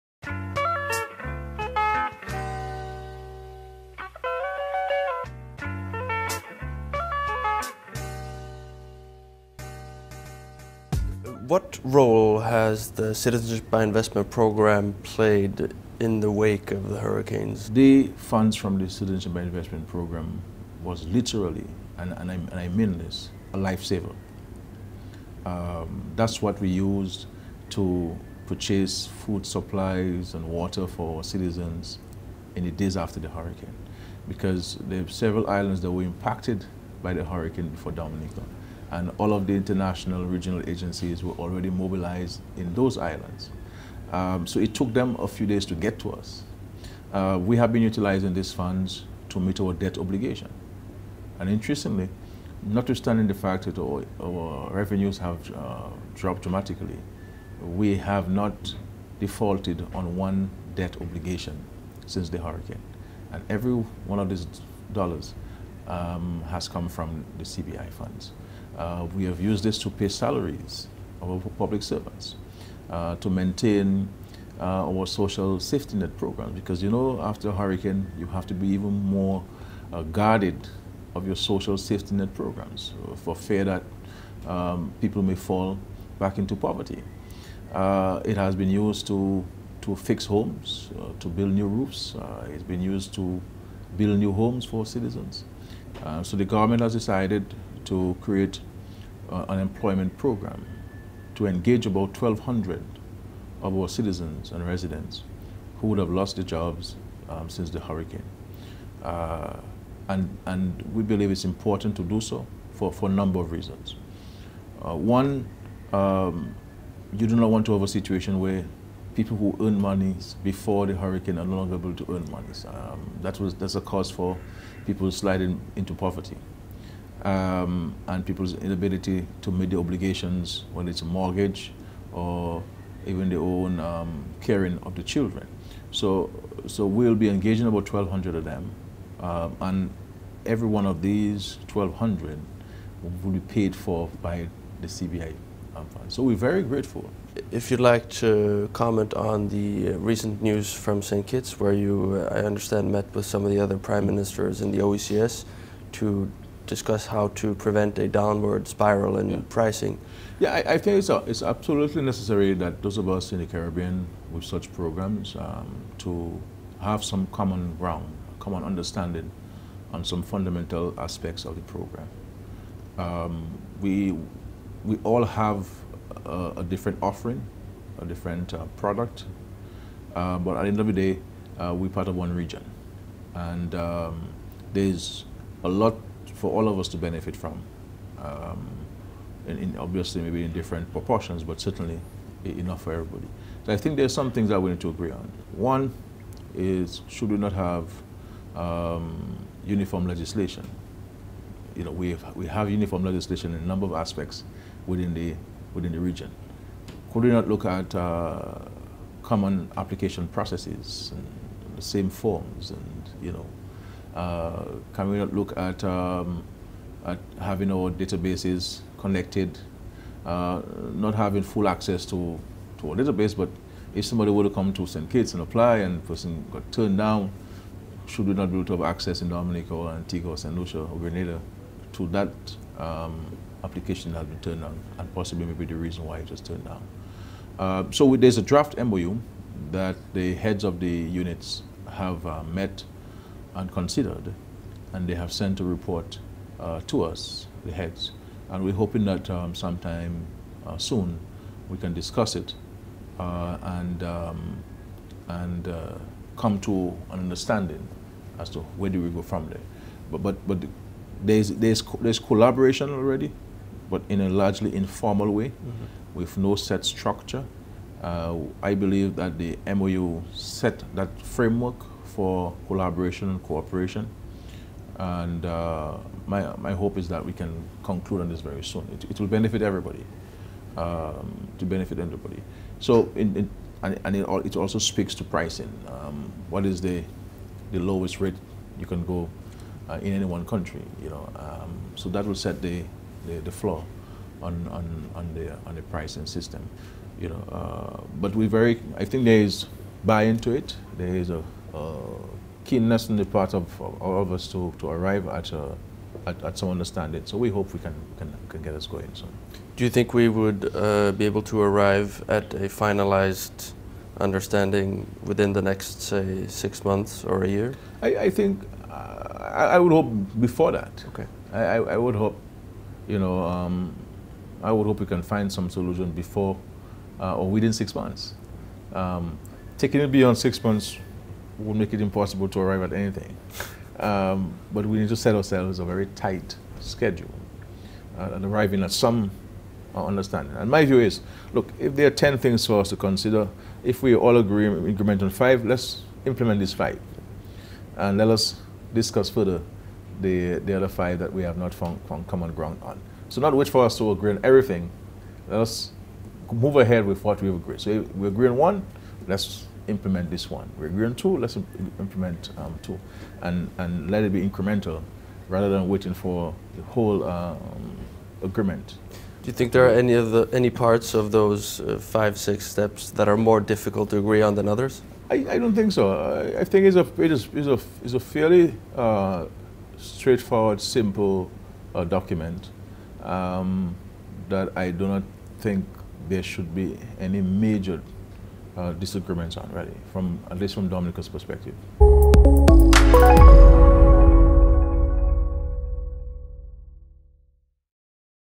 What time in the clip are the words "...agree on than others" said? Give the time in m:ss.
6:14.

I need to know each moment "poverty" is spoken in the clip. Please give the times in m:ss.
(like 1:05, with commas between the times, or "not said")
1:26, 2:05.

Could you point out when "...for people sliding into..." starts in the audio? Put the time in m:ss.
2:04.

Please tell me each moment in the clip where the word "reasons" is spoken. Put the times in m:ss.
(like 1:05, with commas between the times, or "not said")
1:53, 3:55.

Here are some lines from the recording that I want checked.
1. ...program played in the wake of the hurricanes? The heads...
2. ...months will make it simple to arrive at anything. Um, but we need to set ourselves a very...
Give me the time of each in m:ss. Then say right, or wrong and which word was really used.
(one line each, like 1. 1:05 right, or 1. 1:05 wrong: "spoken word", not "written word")
1. 0:14 wrong: "funds", not "heads"
2. 5:30 wrong: "impossible", not "simple".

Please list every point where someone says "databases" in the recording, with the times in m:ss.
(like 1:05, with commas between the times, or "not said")
3:37, 3:42.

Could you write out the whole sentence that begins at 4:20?
But, but, but there's, there's, there's collaboration already, but in a largely informal way mm -hmm.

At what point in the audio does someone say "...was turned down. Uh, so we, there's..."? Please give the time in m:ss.
3:56.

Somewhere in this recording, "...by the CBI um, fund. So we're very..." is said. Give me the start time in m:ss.
2:24.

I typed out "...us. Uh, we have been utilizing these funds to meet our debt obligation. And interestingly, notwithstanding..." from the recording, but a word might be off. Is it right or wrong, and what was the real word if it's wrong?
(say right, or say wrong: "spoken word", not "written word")
right.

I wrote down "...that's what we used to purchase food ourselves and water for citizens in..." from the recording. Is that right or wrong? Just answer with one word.
wrong.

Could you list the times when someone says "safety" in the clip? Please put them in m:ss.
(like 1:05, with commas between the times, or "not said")
1:15, 1:21.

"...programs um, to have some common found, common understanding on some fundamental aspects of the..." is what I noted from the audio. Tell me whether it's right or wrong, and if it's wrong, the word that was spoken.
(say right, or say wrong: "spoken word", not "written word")
wrong: "ground", not "found".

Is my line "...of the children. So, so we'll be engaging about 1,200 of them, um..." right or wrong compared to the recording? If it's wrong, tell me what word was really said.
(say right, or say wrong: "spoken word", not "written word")
right.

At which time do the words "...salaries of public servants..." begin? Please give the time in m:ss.
1:10.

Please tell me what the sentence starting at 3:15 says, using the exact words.
One is should we not have um, uniform legislation?